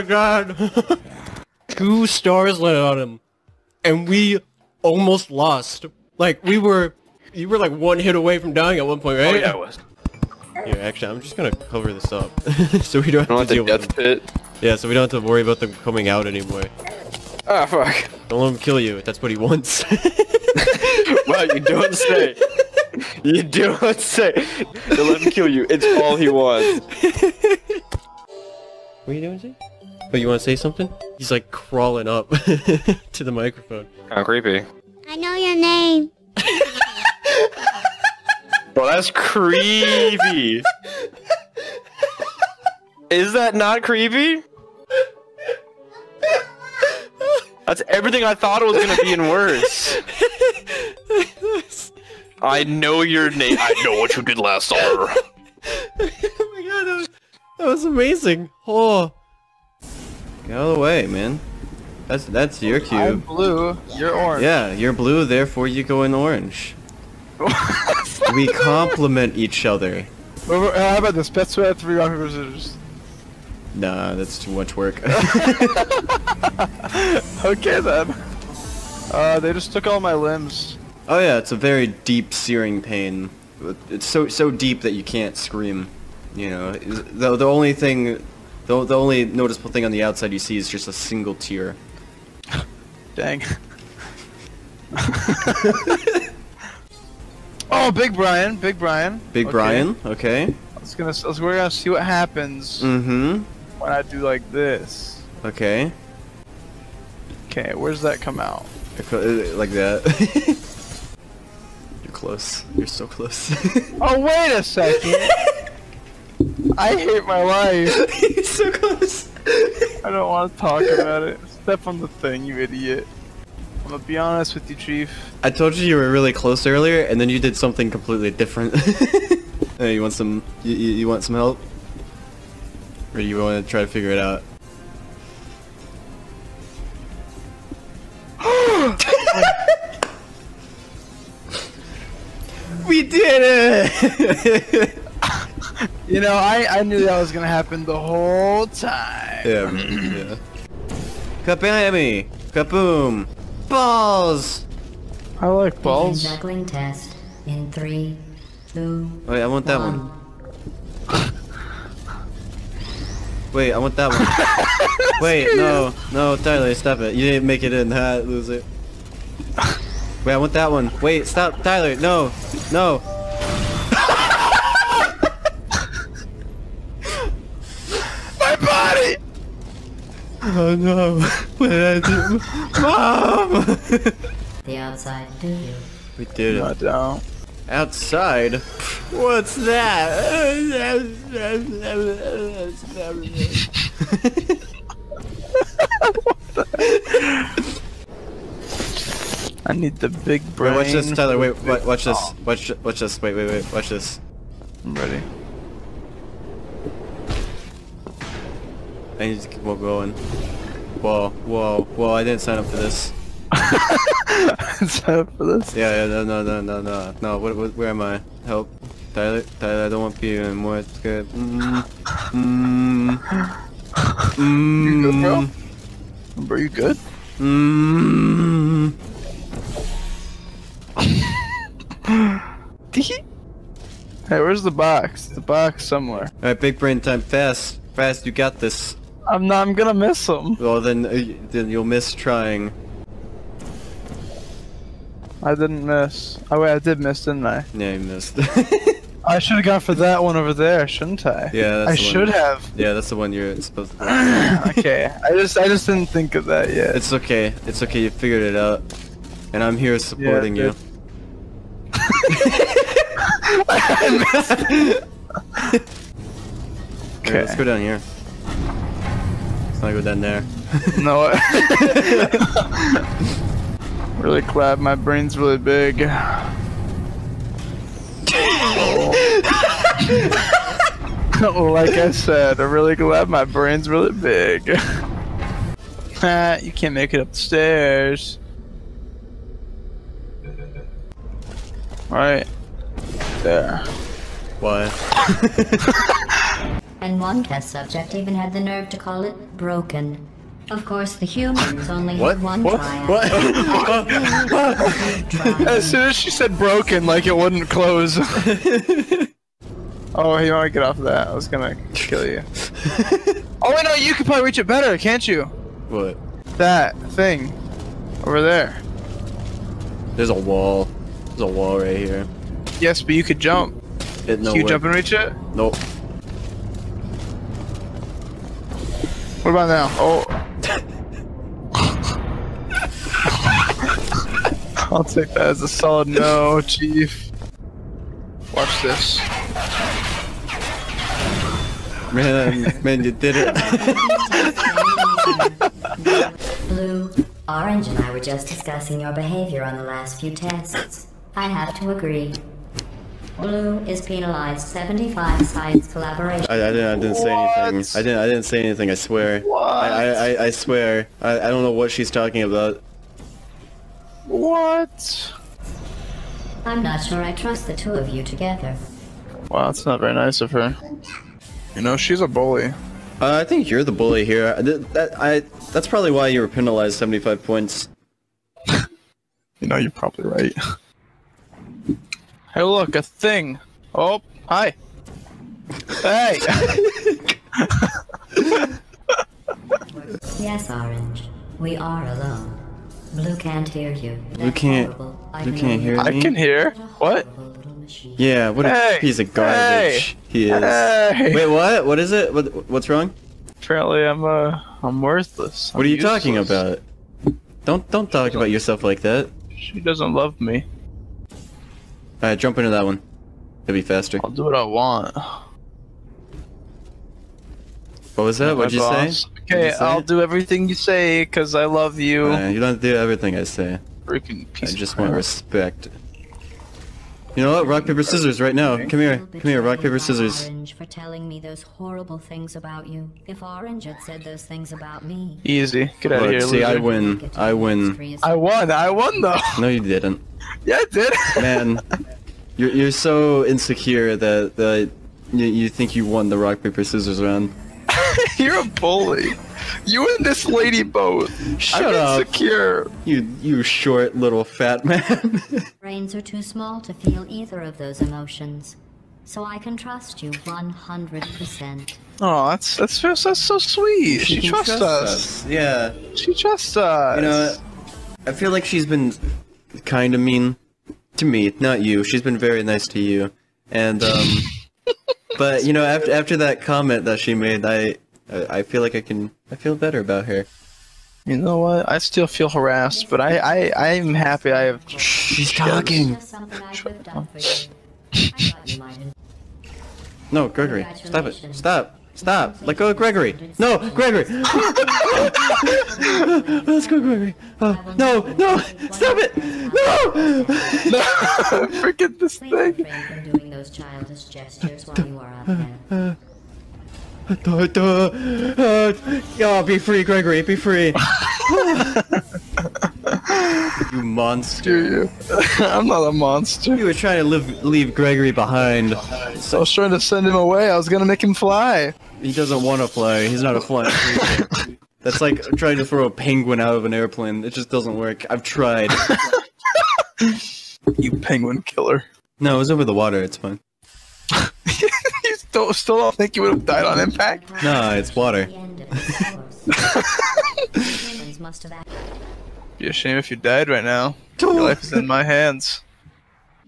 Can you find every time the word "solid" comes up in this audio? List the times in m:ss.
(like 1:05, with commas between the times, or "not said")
5:35.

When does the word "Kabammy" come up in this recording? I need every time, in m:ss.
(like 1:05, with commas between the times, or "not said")
2:31.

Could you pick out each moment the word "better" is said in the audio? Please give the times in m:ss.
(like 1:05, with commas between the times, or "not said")
5:14, 7:59.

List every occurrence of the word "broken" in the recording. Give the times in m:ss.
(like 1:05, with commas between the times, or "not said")
4:59, 5:06.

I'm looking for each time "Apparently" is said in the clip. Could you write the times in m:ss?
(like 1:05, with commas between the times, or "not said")
6:43.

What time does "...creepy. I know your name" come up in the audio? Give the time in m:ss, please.
0:34.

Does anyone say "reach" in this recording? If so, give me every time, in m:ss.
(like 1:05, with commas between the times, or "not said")
5:14, 5:24.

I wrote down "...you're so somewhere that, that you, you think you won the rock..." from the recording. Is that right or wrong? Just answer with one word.
wrong.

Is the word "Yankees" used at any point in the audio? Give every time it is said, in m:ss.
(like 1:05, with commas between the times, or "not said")
not said.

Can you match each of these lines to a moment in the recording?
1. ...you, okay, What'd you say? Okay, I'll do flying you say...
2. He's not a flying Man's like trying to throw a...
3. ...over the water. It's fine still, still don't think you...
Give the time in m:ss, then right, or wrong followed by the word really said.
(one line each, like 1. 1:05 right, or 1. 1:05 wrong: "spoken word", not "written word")
1. 6:58 wrong: "everything", not "flying"
2. 8:43 wrong: "That", not "Man"
3. 8:52 right.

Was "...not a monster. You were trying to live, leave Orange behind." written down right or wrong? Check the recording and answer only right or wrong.
wrong.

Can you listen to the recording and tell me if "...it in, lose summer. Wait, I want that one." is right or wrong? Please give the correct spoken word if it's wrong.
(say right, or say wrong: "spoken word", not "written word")
wrong: "loser", not "summer".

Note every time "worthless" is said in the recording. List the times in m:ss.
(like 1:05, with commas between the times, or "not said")
6:44.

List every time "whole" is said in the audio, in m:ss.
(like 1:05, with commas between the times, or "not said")
2:27.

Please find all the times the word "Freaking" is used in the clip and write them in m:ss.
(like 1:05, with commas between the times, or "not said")
7:04.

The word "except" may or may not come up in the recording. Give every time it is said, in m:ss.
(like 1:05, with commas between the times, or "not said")
not said.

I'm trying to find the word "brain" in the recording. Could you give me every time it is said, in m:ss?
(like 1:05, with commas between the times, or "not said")
3:20, 3:56, 4:34, 4:43, 7:35.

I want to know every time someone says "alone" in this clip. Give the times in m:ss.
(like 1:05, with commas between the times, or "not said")
6:32.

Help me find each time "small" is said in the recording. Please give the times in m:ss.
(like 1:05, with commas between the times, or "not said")
7:36.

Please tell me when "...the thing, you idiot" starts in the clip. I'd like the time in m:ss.
2:01.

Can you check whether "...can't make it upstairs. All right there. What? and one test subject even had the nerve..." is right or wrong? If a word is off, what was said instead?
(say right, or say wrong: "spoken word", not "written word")
right.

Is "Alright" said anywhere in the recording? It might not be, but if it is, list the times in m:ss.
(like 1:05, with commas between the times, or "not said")
3:56, 6:52.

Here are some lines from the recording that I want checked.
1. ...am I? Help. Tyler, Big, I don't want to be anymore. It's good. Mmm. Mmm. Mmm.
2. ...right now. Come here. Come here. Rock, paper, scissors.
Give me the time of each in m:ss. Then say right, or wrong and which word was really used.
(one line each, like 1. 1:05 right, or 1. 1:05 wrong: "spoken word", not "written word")
1. 3:37 wrong: "Tyler", not "Big"
2. 7:08 right.